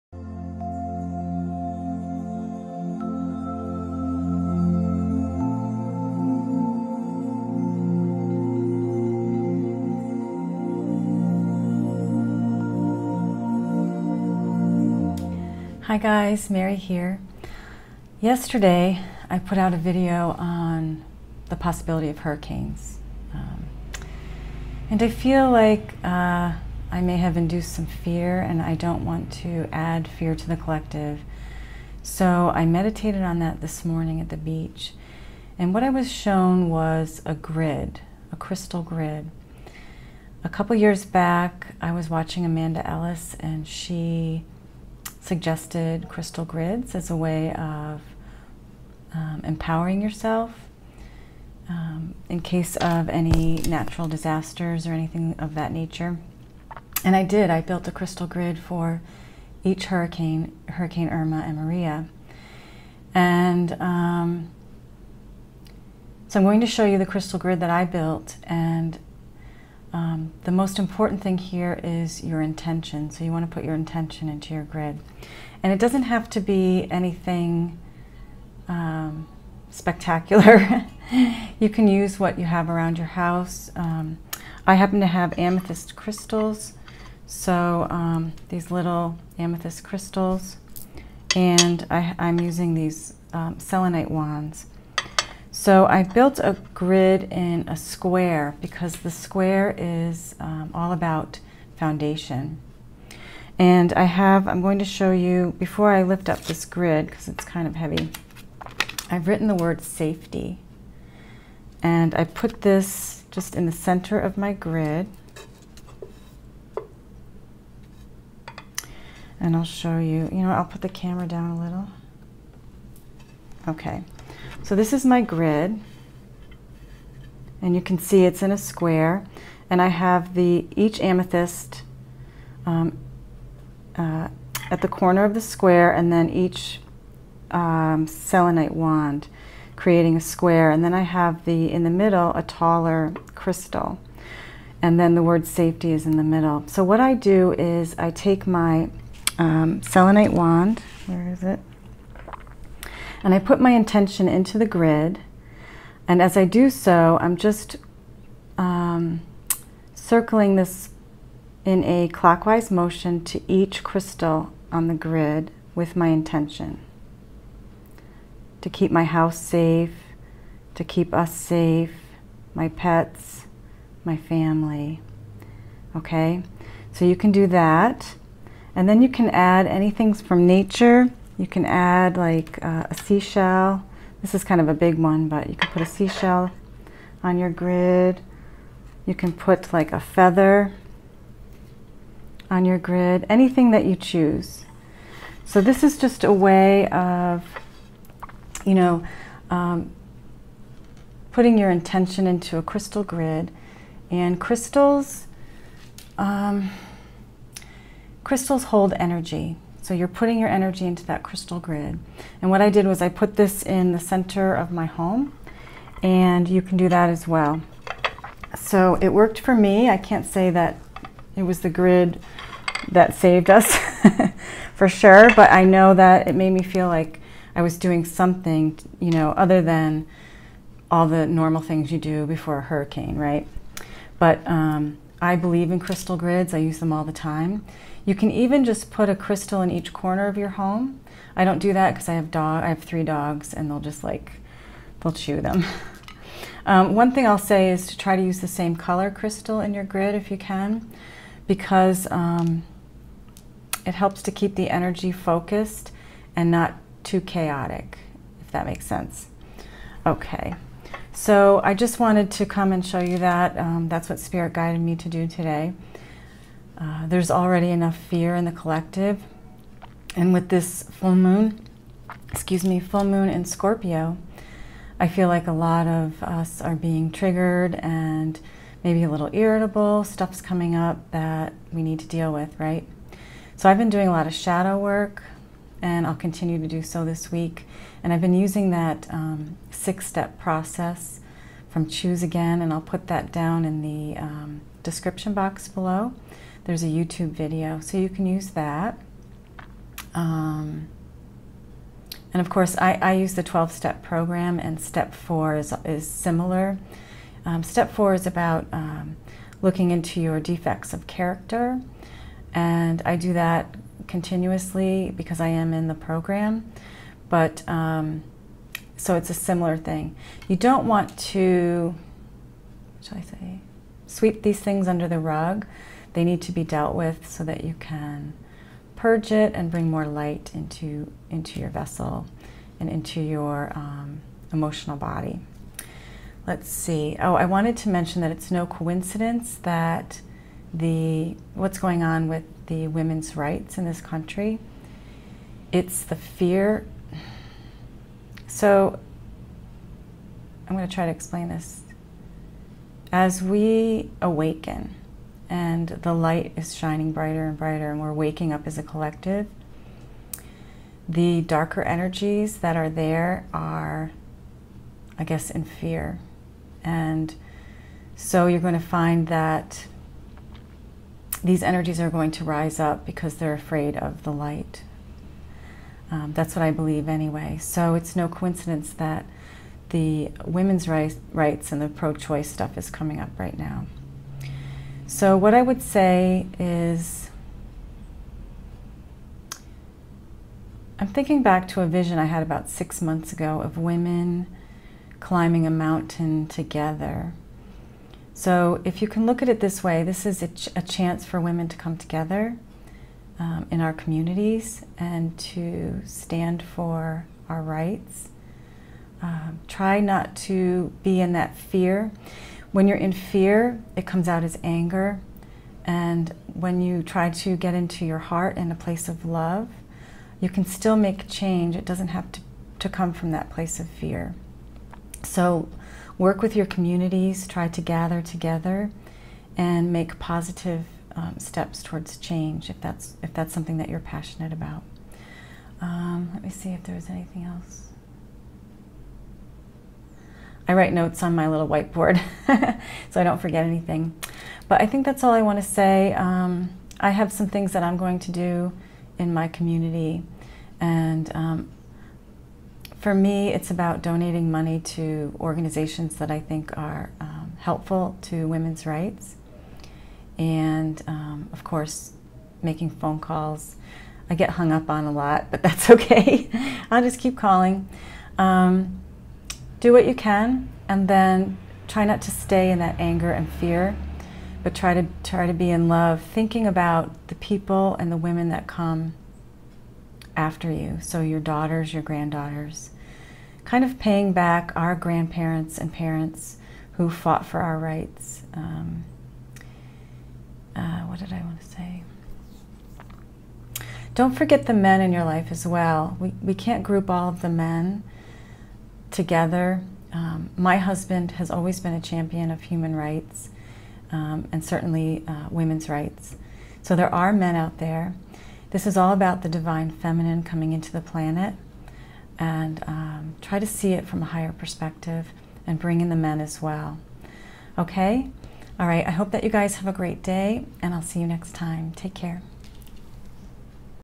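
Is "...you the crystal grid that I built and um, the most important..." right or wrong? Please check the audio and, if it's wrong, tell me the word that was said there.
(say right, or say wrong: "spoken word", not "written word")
right.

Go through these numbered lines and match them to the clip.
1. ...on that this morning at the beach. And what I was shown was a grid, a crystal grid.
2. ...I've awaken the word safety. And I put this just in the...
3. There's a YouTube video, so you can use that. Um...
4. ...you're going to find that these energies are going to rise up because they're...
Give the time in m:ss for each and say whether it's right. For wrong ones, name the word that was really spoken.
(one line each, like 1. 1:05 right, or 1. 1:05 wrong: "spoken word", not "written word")
1. 0:33 right
2. 1:49 wrong: "written", not "awaken"
3. 4:56 right
4. 6:08 right.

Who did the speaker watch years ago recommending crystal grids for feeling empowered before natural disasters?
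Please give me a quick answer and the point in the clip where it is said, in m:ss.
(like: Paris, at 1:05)
Amanda Ellis, at 0:42.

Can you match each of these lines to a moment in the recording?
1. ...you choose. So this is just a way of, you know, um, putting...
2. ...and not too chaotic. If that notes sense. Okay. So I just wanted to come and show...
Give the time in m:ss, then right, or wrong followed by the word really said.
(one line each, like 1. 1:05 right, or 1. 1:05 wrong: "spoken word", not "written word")
1. 3:13 right
2. 4:16 wrong: "makes", not "notes".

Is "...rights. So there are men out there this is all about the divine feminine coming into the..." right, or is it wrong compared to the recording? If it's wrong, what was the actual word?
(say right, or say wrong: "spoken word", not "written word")
right.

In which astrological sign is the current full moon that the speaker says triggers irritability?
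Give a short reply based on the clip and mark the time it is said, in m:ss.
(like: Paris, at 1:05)
Scorpio, at 4:33.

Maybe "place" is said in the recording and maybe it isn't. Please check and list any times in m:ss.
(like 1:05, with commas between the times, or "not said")
6:58, 7:03.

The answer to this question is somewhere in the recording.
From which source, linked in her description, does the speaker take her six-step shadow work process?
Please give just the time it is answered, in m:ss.
4:51.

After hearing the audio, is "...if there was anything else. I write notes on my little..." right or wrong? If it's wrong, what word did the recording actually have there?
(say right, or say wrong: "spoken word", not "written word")
right.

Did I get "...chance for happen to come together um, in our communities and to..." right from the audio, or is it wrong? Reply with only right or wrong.
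wrong.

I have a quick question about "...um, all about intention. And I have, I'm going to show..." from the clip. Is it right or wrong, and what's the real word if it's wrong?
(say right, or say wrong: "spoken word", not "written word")
wrong: "foundation", not "intention".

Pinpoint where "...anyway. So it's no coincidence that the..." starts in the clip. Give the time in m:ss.
6:17.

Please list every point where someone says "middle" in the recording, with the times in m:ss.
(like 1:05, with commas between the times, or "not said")
2:21, 2:26.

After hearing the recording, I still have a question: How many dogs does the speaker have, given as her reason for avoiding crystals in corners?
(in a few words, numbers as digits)
3.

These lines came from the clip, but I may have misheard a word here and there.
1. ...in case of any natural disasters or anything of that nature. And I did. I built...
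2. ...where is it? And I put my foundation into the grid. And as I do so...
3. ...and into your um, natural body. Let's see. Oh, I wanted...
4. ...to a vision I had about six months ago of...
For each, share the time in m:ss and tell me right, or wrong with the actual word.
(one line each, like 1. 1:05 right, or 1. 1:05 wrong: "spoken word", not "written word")
1. 0:52 right
2. 2:31 wrong: "intention", not "foundation"
3. 5:32 wrong: "emotional", not "natural"
4. 6:31 right.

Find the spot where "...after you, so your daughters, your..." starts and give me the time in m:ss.
8:00.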